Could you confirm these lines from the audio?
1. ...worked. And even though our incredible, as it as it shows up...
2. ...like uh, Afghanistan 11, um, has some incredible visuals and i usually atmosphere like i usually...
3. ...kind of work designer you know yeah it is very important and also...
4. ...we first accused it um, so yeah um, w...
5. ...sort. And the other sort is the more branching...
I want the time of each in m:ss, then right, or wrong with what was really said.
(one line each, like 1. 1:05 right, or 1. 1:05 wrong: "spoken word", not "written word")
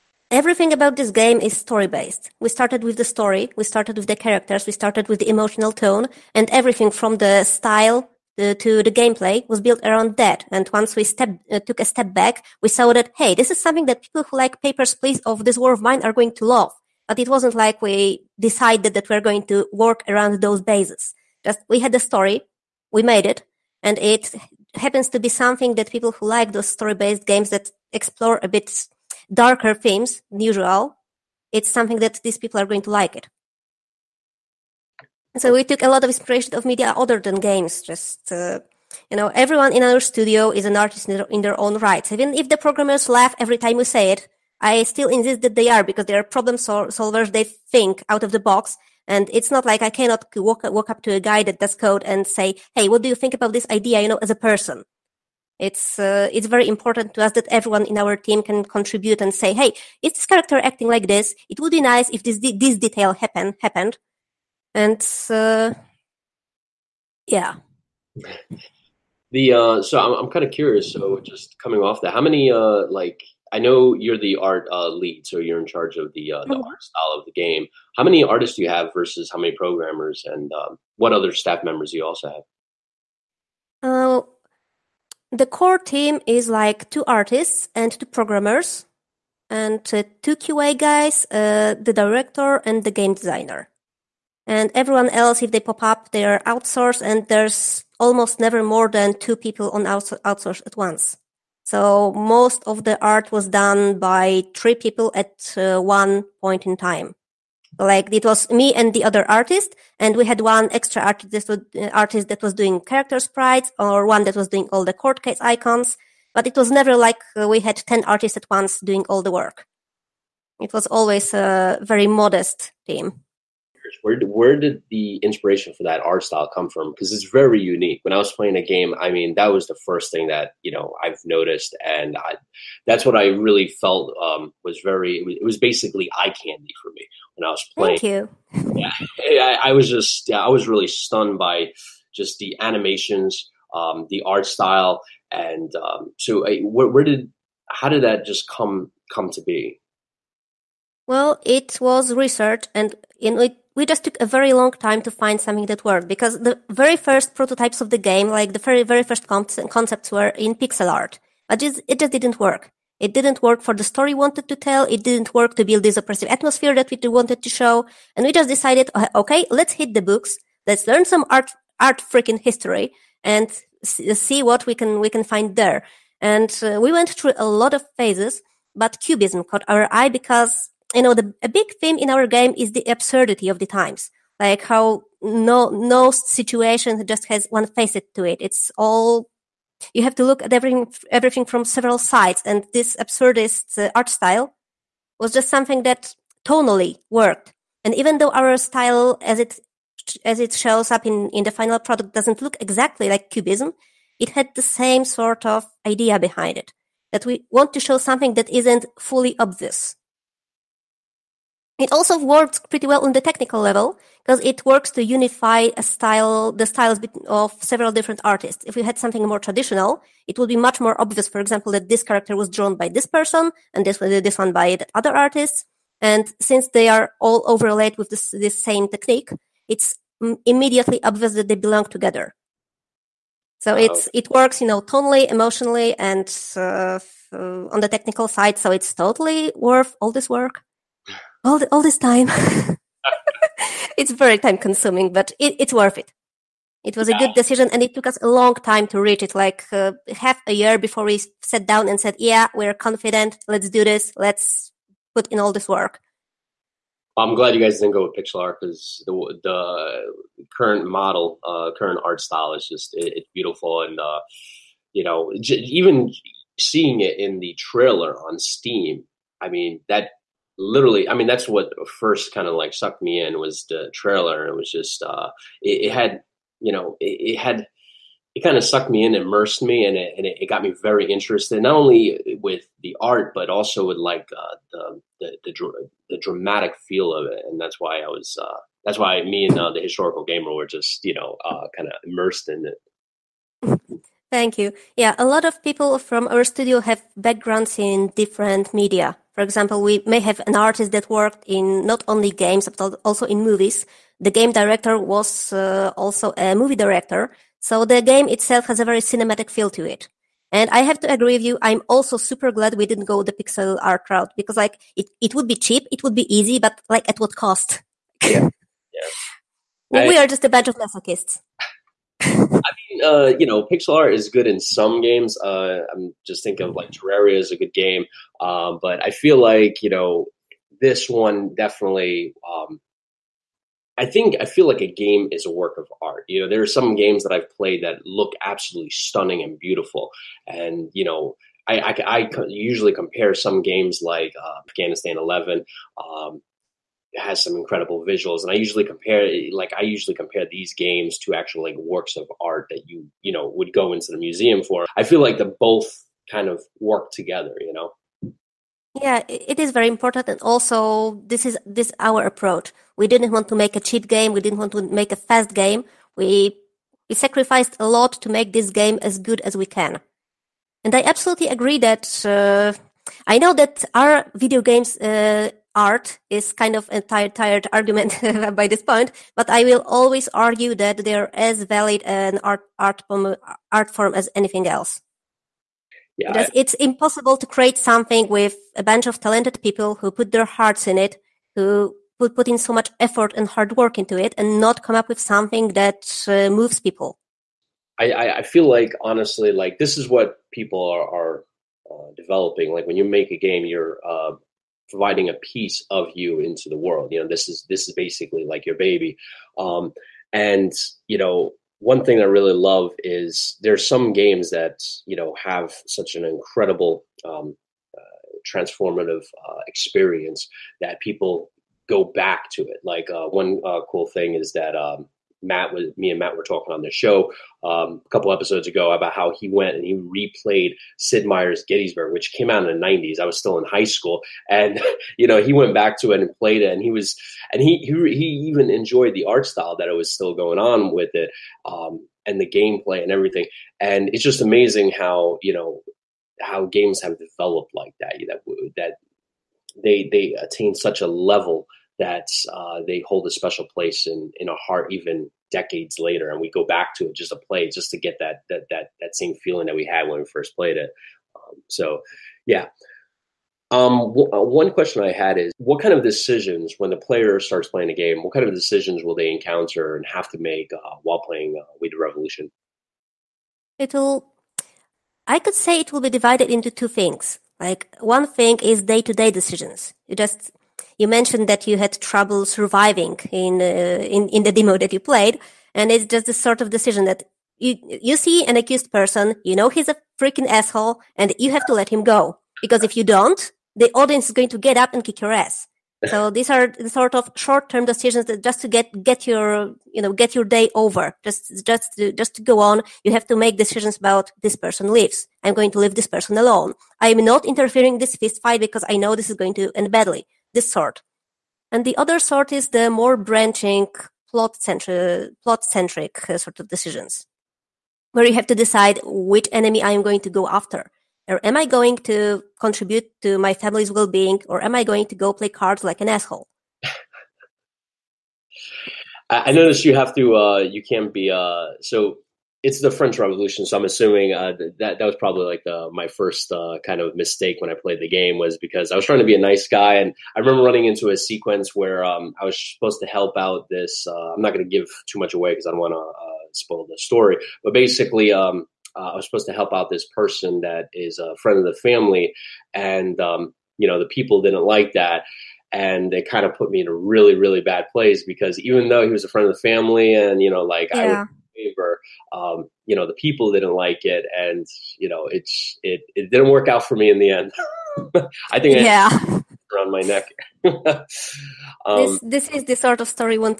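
1. 3:17 wrong: "style", not "incredible"
2. 5:44 wrong: "compare", not "atmosphere"
3. 5:56 wrong: "together", not "designer"
4. 7:40 wrong: "played", not "accused"
5. 8:30 right.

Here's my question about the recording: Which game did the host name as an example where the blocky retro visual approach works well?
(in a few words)
Terraria.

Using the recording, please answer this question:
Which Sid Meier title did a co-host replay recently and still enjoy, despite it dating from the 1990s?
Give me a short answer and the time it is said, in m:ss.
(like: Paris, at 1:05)
Sid Meier's Gettysburg, at 7:10.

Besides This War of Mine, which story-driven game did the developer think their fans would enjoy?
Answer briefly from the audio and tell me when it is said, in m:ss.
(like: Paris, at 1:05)
Papers, Please, at 0:14.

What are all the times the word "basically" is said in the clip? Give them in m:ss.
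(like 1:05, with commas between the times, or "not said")
2:15, 6:47, 9:07.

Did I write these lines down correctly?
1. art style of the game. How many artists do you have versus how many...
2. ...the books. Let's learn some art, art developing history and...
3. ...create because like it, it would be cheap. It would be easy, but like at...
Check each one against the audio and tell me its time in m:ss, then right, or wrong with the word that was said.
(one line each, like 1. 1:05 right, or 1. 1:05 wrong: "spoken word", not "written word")
1. 1:16 right
2. 2:49 wrong: "freaking", not "developing"
3. 5:14 wrong: "route", not "create".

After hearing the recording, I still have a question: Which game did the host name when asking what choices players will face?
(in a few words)
We the Revolution.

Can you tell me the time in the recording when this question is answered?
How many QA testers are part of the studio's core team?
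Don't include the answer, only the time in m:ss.
1:30.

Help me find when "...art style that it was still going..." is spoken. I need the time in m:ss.
7:19.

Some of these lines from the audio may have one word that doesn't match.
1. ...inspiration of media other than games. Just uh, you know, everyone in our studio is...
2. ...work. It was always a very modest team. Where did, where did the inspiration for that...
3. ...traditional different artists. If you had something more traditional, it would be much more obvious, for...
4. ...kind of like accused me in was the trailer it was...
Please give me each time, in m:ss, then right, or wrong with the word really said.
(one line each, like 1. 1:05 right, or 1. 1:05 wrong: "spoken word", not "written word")
1. 0:36 right
2. 1:59 right
3. 3:37 wrong: "several", not "traditional"
4. 4:32 wrong: "sucked", not "accused".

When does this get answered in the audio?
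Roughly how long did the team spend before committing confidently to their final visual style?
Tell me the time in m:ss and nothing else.
4:10.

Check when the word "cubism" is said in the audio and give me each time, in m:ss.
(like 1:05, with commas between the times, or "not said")
2:59, 3:23.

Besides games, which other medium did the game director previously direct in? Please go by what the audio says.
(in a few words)
Movies.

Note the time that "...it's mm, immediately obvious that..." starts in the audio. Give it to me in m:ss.
3:49.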